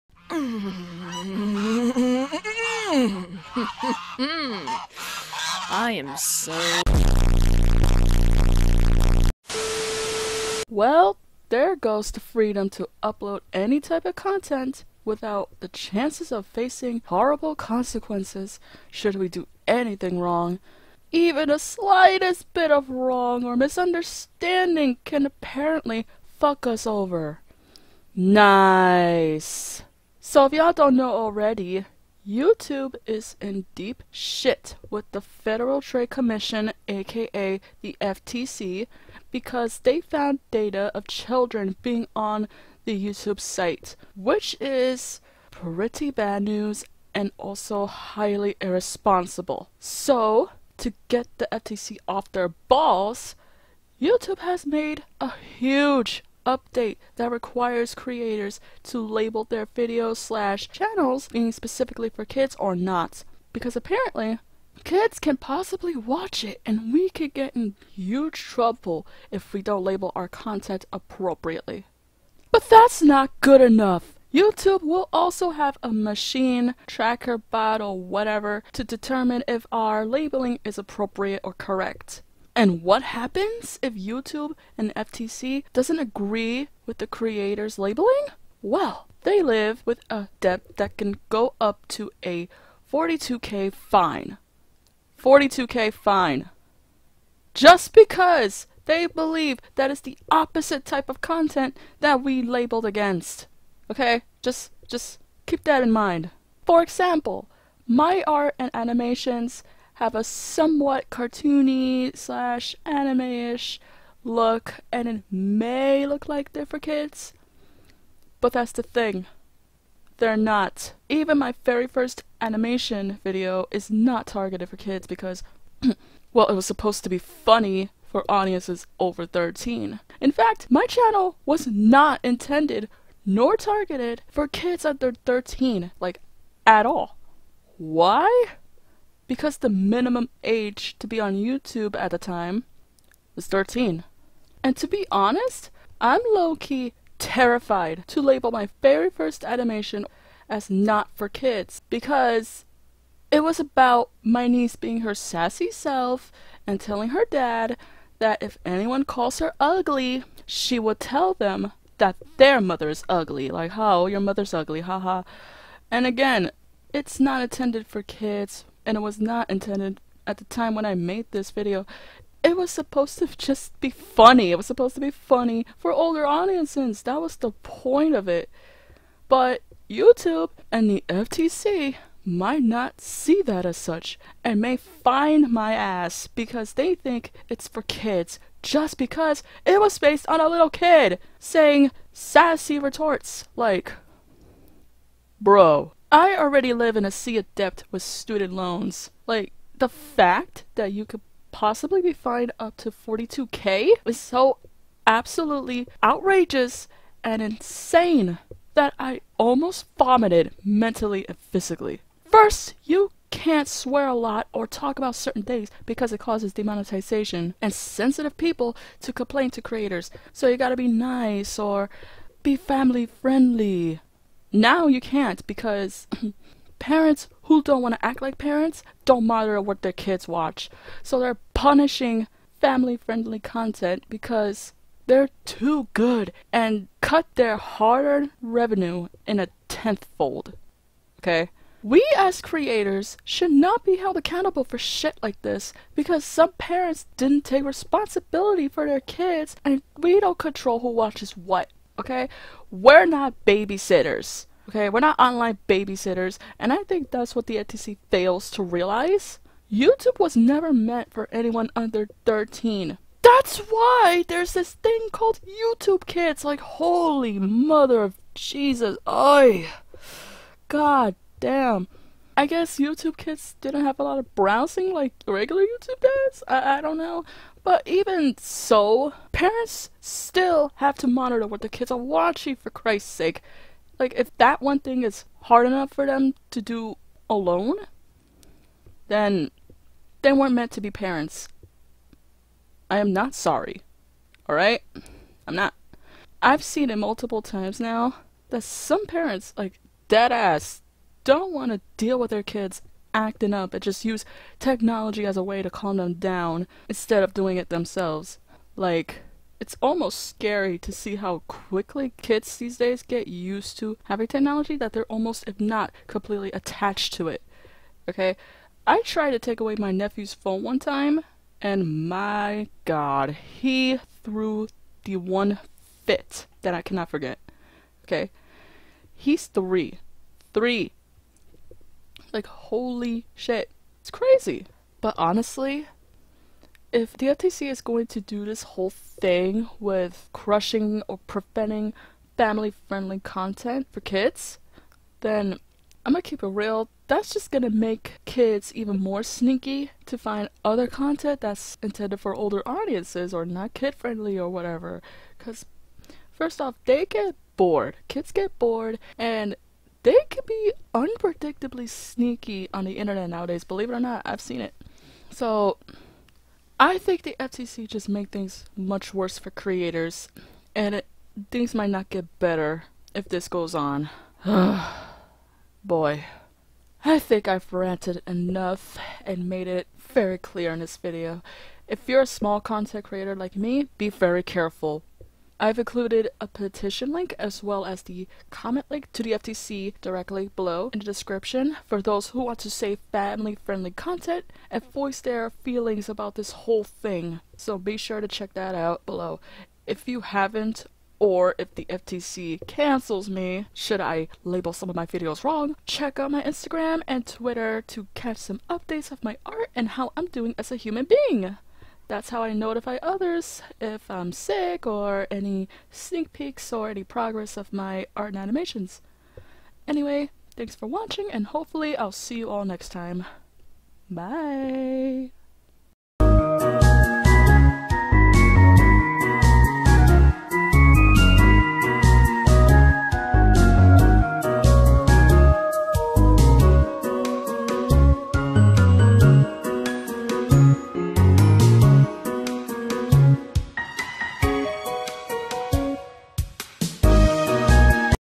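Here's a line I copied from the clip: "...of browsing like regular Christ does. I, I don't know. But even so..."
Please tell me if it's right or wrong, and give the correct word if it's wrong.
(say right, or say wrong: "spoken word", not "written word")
wrong: "YouTube", not "Christ".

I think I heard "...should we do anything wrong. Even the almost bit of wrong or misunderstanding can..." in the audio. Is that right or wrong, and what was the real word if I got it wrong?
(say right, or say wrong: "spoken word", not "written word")
wrong: "slightest", not "almost".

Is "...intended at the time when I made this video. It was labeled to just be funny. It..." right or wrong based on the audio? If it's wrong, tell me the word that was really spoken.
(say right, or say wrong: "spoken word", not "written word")
wrong: "supposed", not "labeled".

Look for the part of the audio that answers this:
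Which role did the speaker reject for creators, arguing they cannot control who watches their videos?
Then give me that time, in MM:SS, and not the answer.
04:15.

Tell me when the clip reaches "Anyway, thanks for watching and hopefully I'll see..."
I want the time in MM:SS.
06:59.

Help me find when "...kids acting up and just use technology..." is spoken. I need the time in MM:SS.
05:02.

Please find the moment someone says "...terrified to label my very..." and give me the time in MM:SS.
02:27.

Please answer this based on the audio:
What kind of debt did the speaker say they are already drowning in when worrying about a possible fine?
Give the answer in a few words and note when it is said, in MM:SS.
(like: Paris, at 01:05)
student loans, at 03:18.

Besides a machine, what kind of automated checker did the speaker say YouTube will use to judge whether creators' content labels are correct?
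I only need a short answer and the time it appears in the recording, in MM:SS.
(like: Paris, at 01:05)
tracker bot, at 01:16.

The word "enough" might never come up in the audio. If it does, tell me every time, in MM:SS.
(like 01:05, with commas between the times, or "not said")
01:13, 04:45, 06:18.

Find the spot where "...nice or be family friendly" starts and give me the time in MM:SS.
03:40.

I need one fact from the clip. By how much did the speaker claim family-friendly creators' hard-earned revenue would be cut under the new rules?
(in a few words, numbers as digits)
tenthfold.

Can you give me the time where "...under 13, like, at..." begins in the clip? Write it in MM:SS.
02:14.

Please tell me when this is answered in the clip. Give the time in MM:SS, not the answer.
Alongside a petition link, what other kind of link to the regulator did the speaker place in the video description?
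06:28.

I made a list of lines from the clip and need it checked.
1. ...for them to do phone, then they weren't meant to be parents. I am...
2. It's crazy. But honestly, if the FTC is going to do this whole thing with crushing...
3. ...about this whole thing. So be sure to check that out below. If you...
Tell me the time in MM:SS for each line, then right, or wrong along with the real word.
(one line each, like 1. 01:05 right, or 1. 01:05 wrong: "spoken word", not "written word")
1. 04:45 wrong: "alone", not "phone"
2. 05:33 right
3. 06:36 right.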